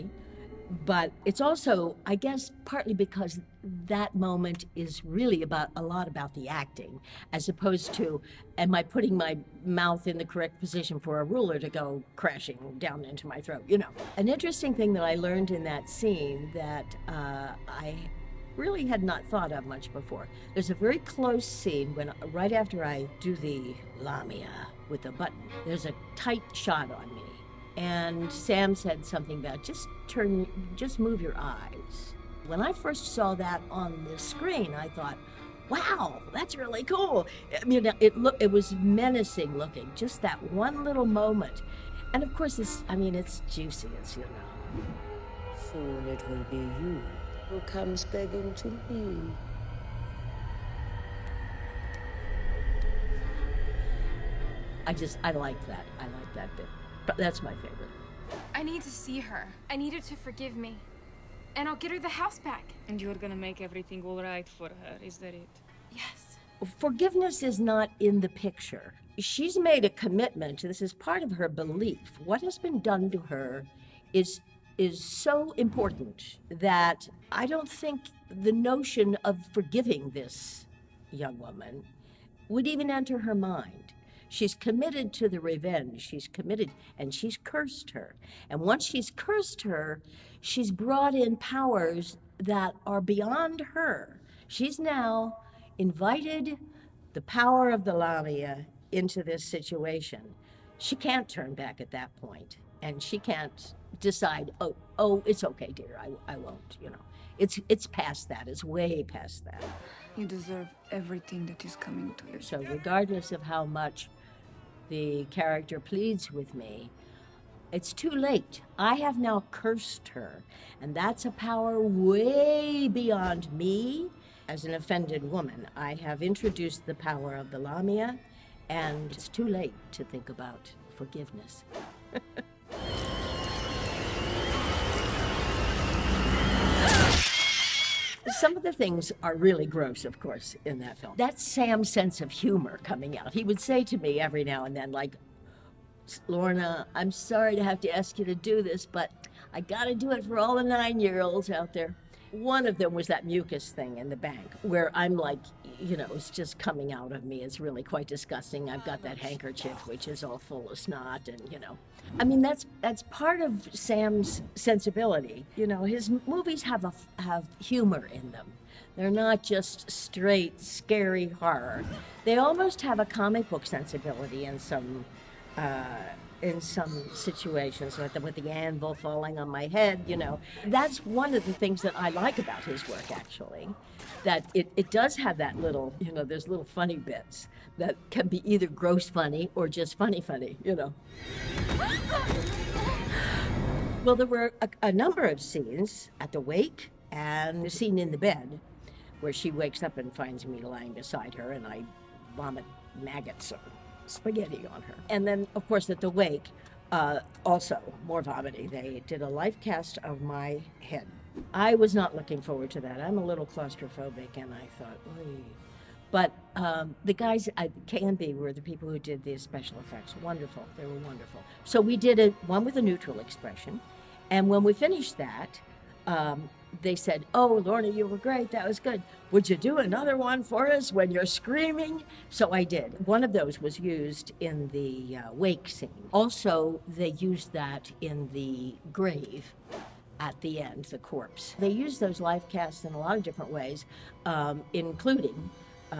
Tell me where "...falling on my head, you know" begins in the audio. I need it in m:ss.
2:58.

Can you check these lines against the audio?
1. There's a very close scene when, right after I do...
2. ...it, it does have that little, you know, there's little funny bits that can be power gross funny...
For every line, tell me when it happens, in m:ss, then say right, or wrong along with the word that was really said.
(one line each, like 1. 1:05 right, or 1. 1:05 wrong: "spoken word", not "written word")
1. 0:20 right
2. 3:04 wrong: "either", not "power".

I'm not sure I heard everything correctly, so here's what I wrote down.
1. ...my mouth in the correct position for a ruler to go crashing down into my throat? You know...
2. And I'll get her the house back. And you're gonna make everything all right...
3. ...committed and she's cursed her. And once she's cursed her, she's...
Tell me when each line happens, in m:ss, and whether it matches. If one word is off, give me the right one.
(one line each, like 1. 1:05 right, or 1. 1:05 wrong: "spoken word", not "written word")
1. 0:09 right
2. 1:01 right
3. 1:26 right.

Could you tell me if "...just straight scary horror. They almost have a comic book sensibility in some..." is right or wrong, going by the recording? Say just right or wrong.
right.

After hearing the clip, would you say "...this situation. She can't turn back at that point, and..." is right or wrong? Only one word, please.
right.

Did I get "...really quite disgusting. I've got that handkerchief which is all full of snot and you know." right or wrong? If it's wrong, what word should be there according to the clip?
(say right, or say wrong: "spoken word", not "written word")
right.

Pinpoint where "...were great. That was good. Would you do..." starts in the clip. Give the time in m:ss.
3:48.